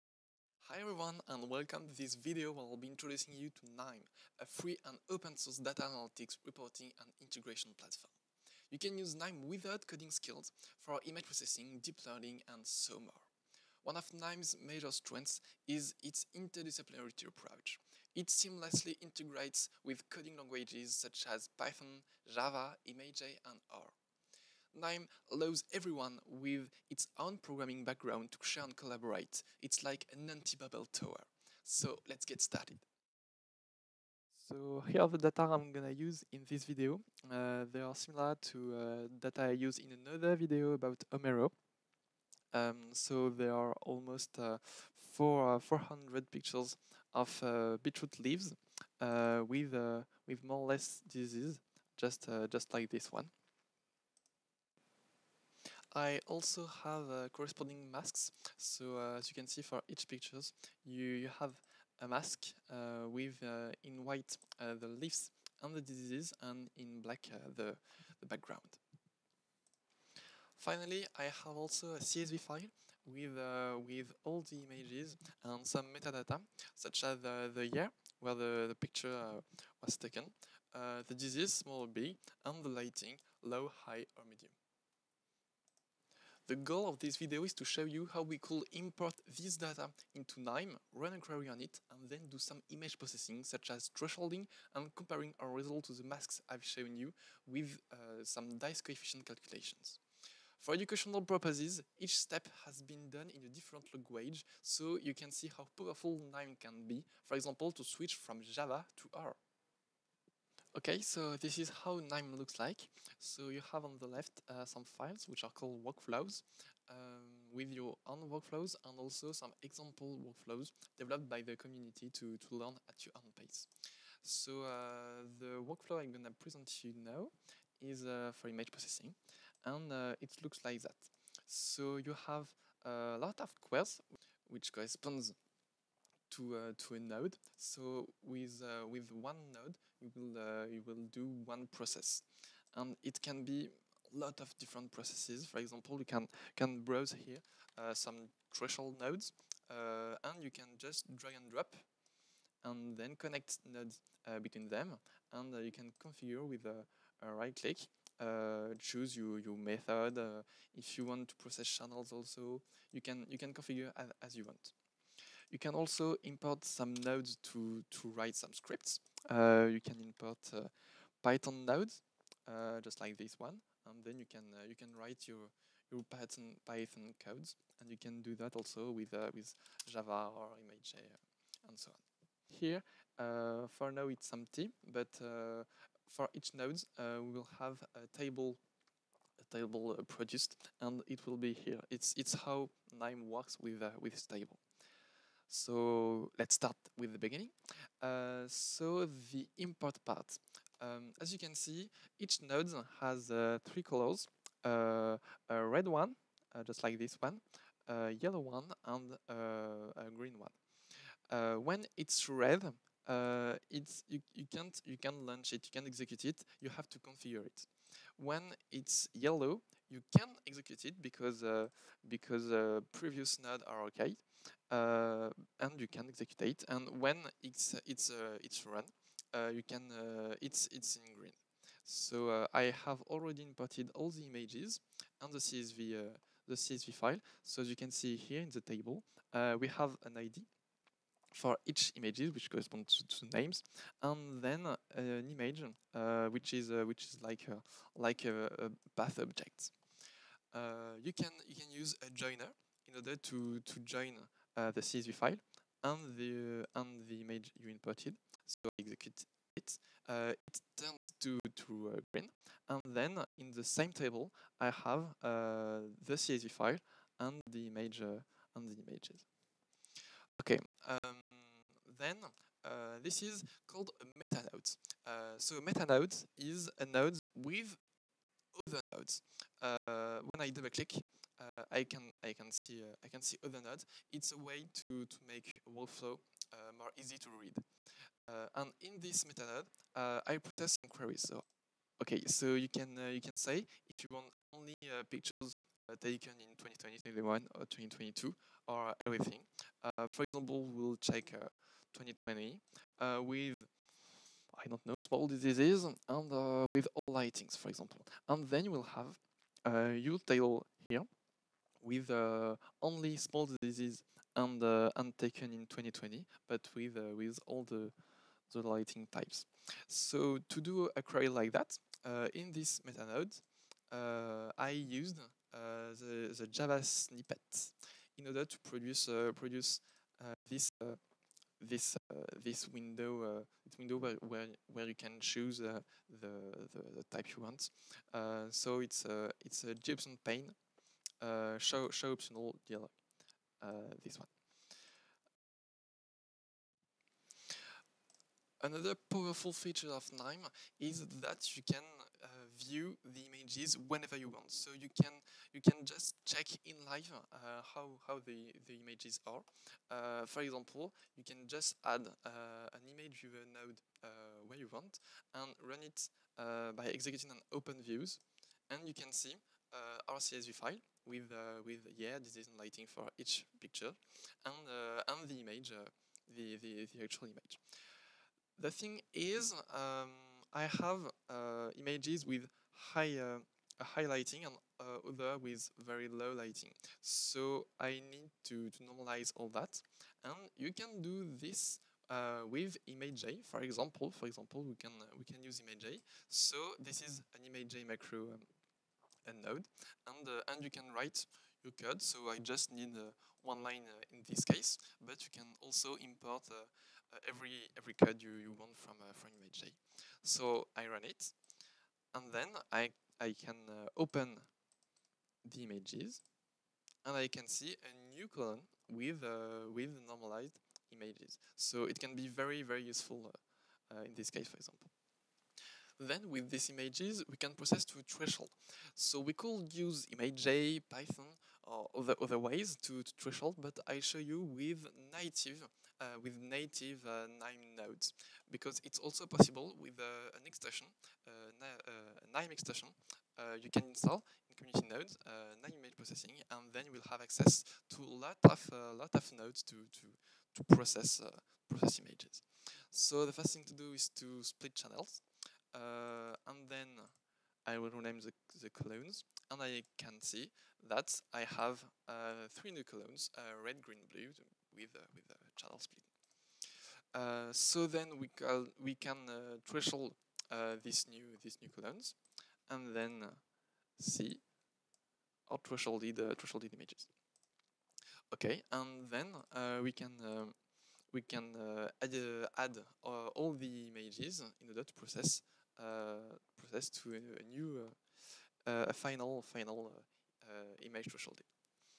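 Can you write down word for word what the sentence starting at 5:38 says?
so it's a it's a JOptionPane show show optional dialog.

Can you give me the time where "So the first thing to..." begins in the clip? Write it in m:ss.
7:32.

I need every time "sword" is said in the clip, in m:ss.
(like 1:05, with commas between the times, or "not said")
not said.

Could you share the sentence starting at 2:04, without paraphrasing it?
So uh, the workflow I'm going to present you now is uh, for image processing and uh, it looks like that.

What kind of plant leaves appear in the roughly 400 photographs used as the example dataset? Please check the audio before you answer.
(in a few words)
Beetroot.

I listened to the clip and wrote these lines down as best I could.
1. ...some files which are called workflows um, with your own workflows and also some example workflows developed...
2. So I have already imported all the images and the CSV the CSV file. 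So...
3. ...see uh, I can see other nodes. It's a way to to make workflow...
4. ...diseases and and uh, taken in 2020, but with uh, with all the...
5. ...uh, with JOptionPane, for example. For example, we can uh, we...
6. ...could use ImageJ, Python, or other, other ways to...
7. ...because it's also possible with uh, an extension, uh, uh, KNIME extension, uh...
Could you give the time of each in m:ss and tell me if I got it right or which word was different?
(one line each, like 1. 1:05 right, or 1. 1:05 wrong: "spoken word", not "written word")
1. 1:54 right
2. 3:51 right
3. 4:42 right
4. 5:13 right
5. 6:32 wrong: "ImageJ", not "JOptionPane"
6. 7:09 right
7. 7:18 right.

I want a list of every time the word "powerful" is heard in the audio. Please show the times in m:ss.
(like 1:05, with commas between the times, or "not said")
1:45, 5:49.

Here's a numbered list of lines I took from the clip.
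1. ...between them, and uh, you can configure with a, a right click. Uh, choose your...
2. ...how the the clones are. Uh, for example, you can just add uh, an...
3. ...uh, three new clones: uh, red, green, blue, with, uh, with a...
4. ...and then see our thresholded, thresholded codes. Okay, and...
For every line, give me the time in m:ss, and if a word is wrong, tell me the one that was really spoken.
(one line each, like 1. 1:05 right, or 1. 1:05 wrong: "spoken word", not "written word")
1. 2:34 right
2. 5:58 wrong: "images", not "clones"
3. 7:42 right
4. 7:52 wrong: "images", not "codes".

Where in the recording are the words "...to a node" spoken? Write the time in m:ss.
2:16.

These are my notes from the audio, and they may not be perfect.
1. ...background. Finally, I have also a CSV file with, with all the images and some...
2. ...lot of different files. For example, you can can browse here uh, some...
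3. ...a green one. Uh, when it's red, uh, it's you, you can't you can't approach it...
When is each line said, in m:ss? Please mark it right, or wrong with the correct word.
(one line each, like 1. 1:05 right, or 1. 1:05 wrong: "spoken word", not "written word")
1. 1:08 right
2. 2:24 wrong: "processes", not "files"
3. 3:29 wrong: "launch", not "approach".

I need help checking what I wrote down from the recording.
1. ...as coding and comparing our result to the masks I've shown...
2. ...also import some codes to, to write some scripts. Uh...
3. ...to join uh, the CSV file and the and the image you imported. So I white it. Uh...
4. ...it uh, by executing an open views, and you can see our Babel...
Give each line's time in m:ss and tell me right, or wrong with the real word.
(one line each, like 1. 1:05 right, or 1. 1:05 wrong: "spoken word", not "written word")
1. 1:33 wrong: "thresholding", not "coding"
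2. 2:45 wrong: "nodes", not "codes"
3. 4:13 wrong: "execute", not "white"
4. 6:05 wrong: "CSV", not "Babel".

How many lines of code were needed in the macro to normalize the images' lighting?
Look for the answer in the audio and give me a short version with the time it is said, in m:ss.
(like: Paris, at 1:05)
1, at 6:43.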